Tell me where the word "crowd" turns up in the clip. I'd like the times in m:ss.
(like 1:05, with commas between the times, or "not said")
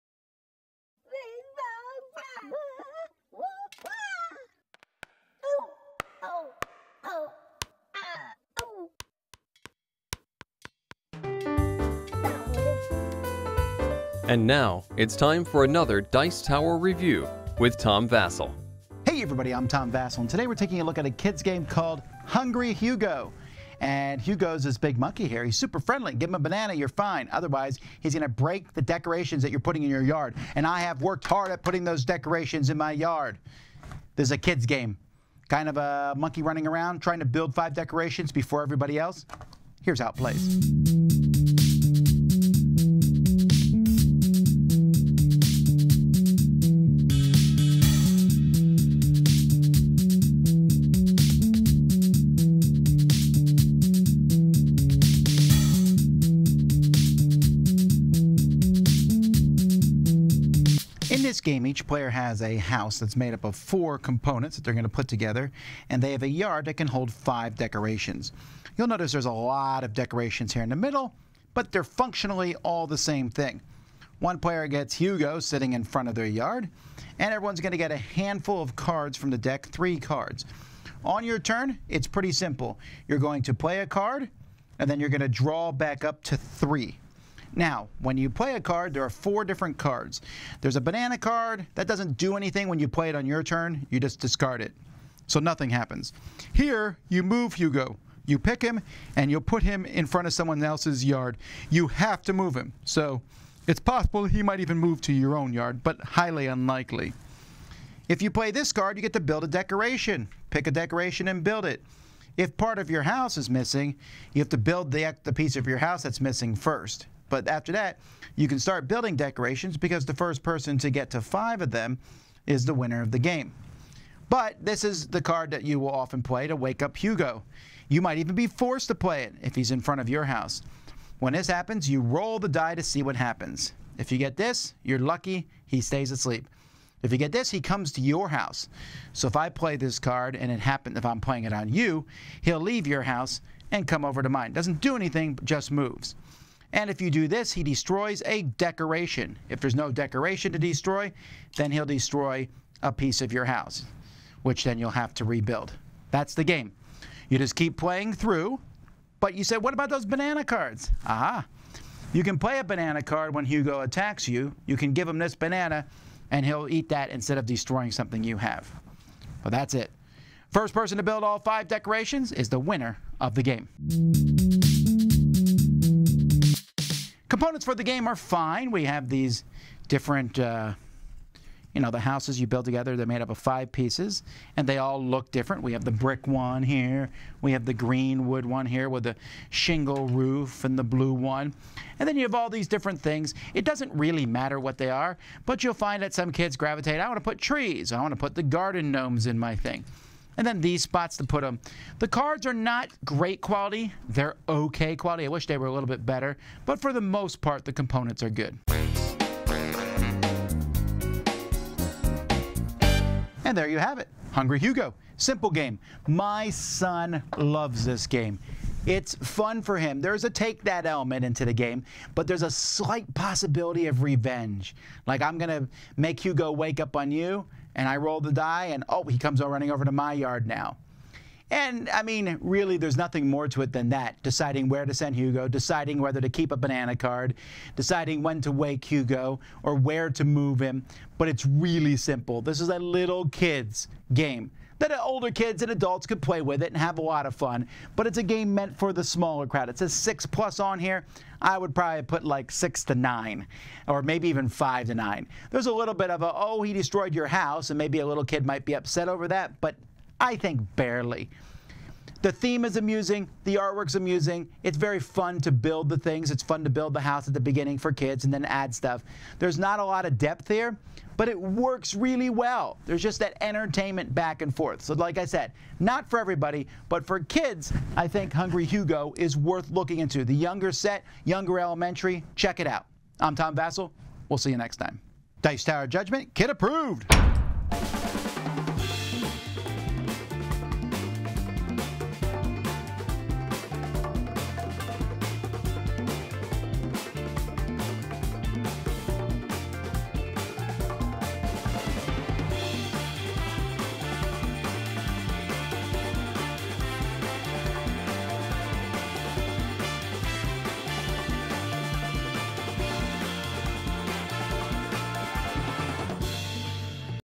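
4:09.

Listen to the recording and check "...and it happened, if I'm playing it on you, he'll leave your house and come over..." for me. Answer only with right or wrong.
right.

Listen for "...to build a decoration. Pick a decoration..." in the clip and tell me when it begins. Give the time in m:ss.
1:49.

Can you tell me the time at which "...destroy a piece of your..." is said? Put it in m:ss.
2:31.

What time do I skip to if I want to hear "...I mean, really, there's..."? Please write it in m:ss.
3:51.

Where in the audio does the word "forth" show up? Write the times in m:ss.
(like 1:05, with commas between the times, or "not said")
4:34.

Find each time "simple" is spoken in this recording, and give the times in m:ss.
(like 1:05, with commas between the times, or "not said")
1:22, 3:35, 4:01.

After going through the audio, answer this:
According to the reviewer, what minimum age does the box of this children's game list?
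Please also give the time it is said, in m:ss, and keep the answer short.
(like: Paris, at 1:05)
6+, at 4:09.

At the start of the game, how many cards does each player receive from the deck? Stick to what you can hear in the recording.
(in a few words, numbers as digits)
3.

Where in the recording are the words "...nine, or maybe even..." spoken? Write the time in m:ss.
4:12.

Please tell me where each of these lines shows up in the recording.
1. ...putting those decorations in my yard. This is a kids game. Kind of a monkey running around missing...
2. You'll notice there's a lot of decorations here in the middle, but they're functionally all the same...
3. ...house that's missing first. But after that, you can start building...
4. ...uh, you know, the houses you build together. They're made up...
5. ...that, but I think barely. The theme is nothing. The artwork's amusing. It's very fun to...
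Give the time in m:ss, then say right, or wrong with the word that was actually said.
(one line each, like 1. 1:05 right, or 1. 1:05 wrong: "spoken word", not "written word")
1. 0:31 wrong: "trying", not "missing"
2. 1:08 right
3. 1:55 right
4. 3:00 right
5. 4:19 wrong: "amusing", not "nothing".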